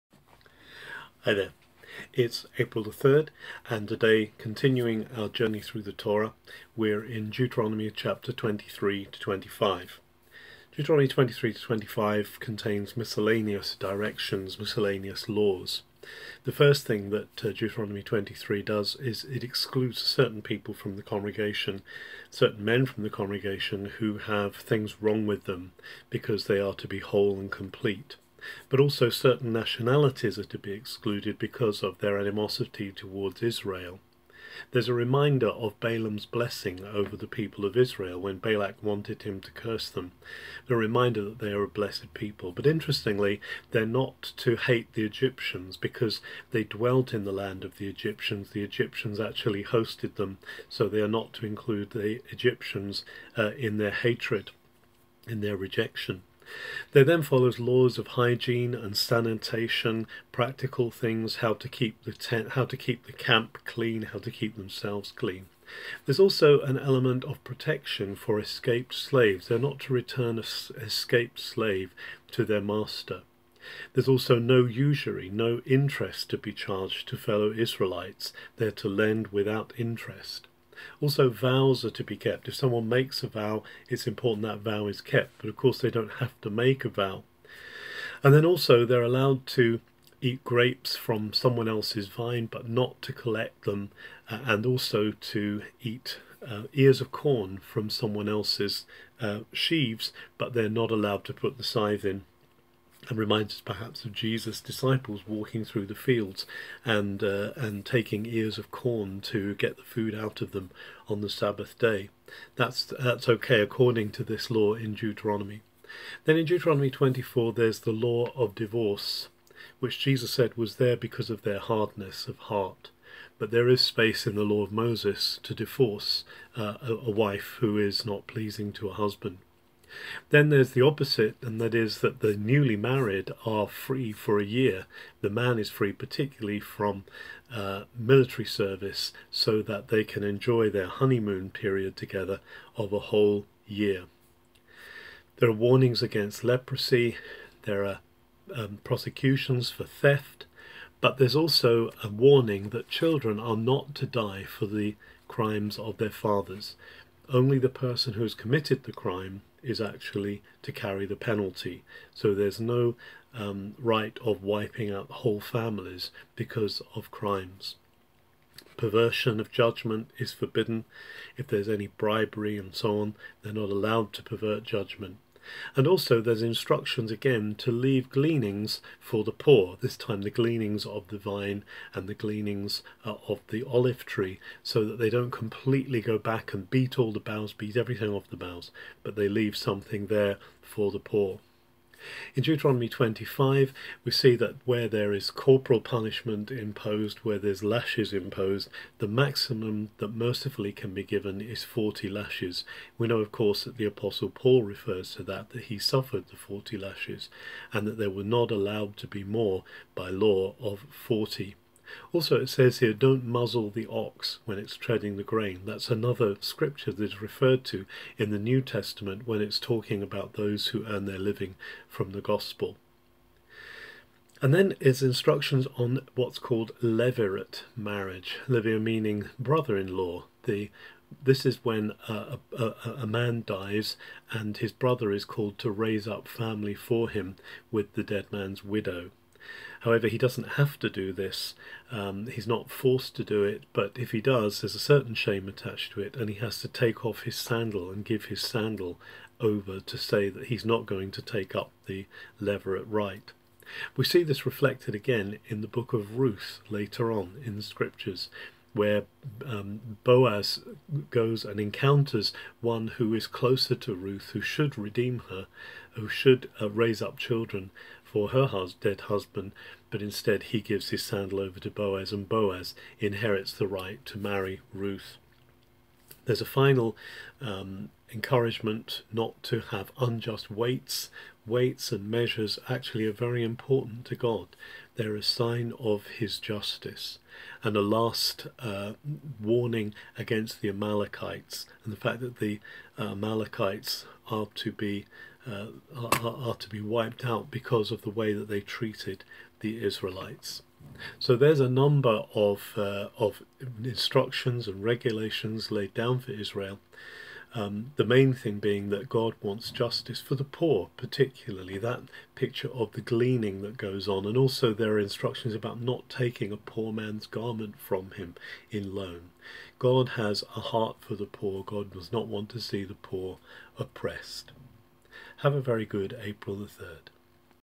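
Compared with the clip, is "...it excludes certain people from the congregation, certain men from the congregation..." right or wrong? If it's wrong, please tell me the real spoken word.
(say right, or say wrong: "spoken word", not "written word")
right.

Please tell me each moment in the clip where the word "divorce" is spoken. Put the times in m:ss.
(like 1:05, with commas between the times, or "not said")
1:58, 2:05.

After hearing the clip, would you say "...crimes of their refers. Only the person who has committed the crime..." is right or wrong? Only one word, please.
wrong.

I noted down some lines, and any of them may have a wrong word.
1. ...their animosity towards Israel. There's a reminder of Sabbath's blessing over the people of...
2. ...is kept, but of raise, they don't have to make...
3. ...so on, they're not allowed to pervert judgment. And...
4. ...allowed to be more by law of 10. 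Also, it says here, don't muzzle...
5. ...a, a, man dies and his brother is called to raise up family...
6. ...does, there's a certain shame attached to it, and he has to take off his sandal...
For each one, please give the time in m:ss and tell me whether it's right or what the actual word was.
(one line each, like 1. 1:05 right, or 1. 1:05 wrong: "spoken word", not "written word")
1. 0:31 wrong: "Balaam", not "Sabbath"
2. 1:24 wrong: "course", not "raise"
3. 2:52 right
4. 3:28 wrong: "40", not "10"
5. 3:52 right
6. 4:04 right.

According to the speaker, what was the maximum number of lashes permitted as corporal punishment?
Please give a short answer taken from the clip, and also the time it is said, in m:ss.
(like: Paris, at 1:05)
40, at 3:18.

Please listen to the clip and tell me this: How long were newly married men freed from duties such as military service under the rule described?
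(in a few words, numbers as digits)
A year.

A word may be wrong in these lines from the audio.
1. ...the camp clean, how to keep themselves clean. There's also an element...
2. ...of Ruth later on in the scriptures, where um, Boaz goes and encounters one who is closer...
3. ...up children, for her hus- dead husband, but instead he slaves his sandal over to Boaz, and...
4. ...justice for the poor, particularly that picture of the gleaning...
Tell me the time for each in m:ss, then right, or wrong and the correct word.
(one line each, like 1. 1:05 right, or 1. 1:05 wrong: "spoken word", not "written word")
1. 1:03 right
2. 4:15 right
3. 4:27 wrong: "gives", not "slaves"
4. 5:09 right.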